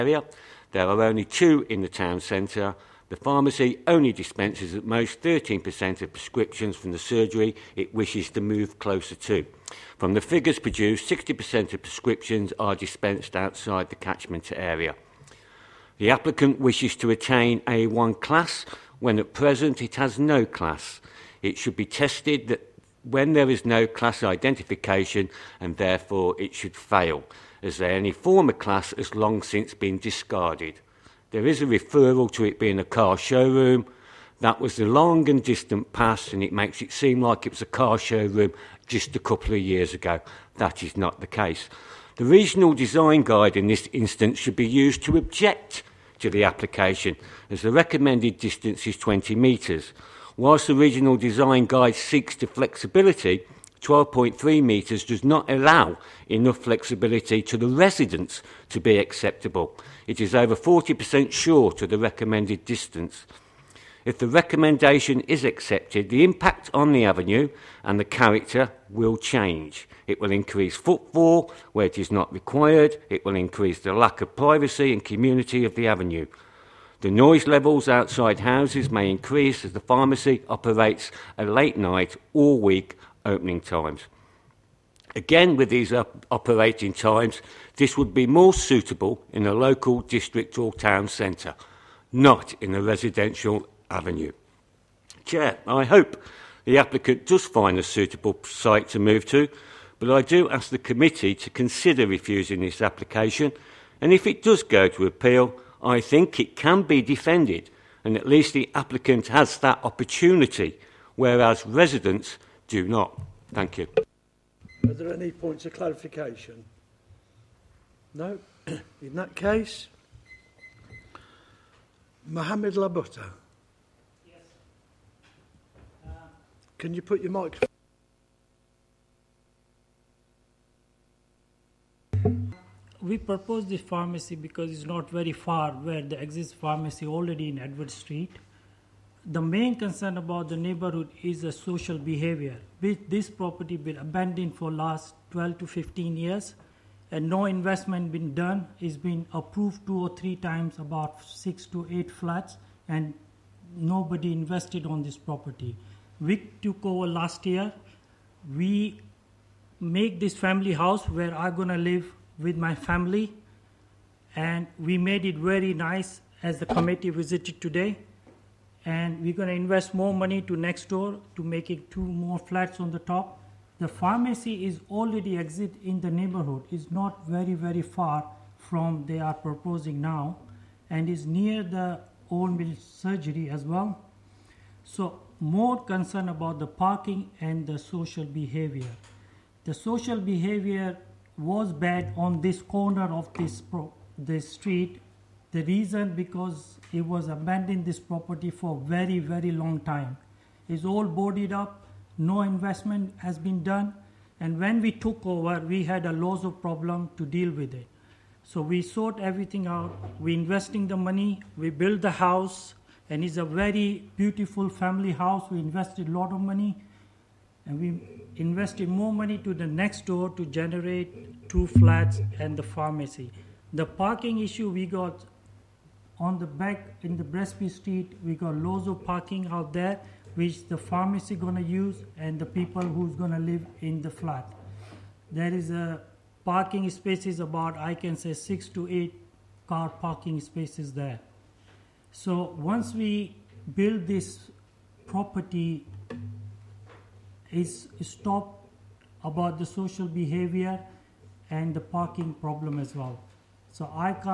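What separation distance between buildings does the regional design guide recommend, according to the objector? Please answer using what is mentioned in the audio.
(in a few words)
20 metres.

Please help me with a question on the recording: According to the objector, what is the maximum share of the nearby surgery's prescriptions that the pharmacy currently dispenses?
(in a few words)
13%.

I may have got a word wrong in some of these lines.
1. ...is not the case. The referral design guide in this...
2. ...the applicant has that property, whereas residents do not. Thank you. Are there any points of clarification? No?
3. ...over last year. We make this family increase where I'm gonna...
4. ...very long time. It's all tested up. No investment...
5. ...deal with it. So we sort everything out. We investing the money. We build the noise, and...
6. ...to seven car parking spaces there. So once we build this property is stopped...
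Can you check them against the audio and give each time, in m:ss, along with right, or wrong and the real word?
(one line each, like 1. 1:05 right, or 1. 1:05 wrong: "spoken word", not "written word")
1. 0:40 wrong: "regional", not "referral"
2. 1:48 wrong: "opportunity", not "property"
3. 2:36 wrong: "house", not "increase"
4. 3:19 wrong: "boarded", not "tested"
5. 3:27 wrong: "house", not "noise"
6. 3:58 wrong: "eight", not "seven".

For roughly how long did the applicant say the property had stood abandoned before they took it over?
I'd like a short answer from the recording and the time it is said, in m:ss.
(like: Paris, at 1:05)
12 to 15 years, at 2:25.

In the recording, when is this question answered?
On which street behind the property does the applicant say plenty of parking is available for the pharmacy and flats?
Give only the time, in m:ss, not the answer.
3:47.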